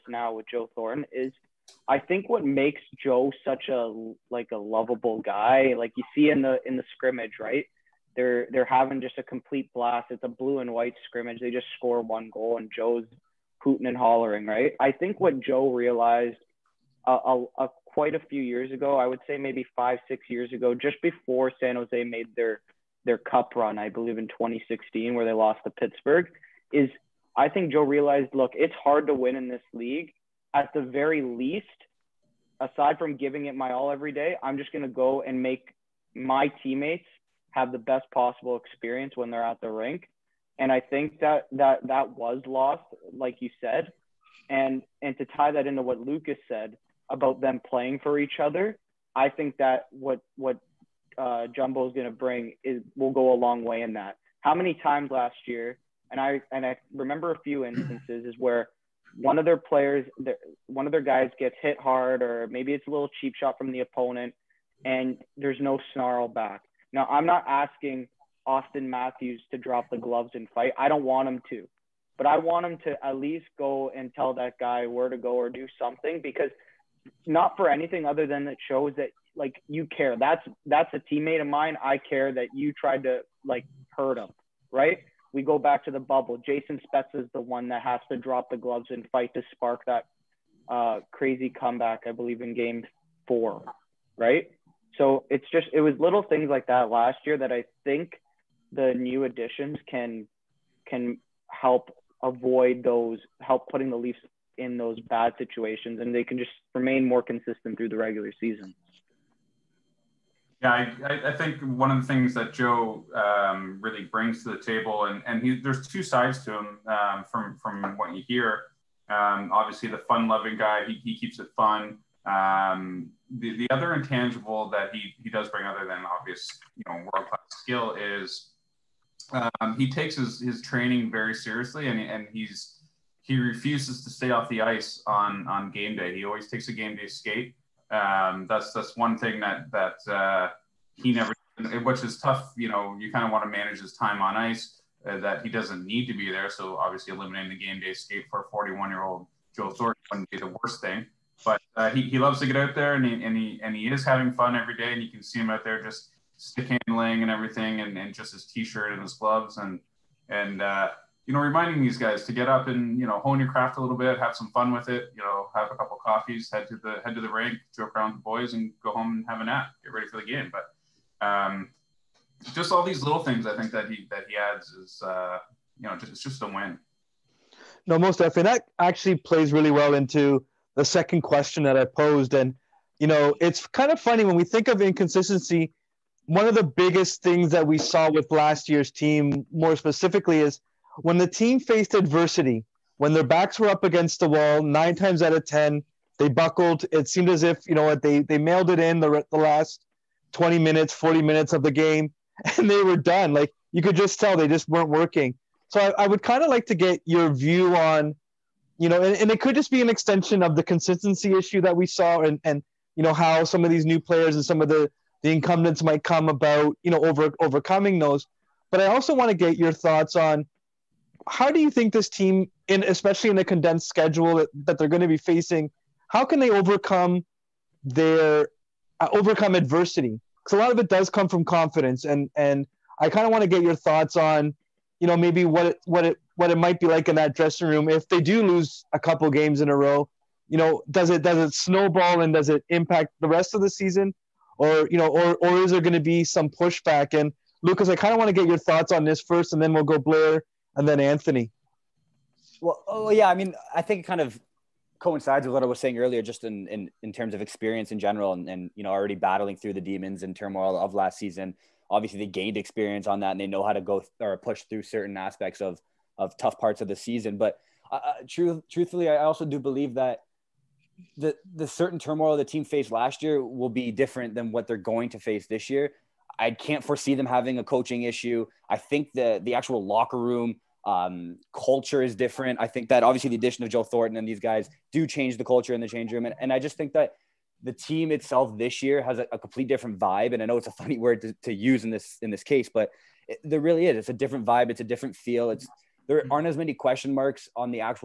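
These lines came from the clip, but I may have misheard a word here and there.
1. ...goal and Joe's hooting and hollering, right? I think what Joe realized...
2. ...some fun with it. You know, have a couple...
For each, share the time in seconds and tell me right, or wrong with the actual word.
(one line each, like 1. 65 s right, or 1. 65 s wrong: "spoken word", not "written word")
1. 12 s right
2. 164 s right.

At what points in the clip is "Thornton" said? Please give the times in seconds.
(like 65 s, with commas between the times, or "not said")
0 s, 149 s, 283 s.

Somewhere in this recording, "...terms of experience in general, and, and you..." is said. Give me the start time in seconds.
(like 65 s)
257 s.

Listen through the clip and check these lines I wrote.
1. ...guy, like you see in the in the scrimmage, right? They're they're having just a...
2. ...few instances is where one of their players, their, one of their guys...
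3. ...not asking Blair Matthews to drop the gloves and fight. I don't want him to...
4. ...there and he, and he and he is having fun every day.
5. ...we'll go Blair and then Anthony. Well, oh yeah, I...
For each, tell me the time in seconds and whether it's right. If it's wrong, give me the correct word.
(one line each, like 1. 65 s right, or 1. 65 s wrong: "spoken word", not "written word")
1. 5 s right
2. 57 s right
3. 67 s wrong: "Auston", not "Blair"
4. 152 s right
5. 249 s right.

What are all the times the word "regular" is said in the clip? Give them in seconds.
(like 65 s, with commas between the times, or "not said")
107 s.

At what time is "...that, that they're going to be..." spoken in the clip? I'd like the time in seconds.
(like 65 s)
224 s.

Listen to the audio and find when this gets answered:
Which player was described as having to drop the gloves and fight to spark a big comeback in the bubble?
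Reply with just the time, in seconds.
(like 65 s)
86 s.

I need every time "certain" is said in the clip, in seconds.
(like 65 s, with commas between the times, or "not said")
264 s, 271 s.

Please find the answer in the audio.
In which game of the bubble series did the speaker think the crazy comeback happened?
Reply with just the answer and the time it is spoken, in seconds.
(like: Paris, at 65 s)
Game 4, at 92 s.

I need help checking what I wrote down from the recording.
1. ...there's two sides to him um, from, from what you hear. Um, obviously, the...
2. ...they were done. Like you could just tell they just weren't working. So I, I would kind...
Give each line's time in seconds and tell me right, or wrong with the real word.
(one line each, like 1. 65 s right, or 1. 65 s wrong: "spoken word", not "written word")
1. 115 s right
2. 202 s right.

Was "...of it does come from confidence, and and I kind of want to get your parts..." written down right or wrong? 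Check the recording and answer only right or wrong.
wrong.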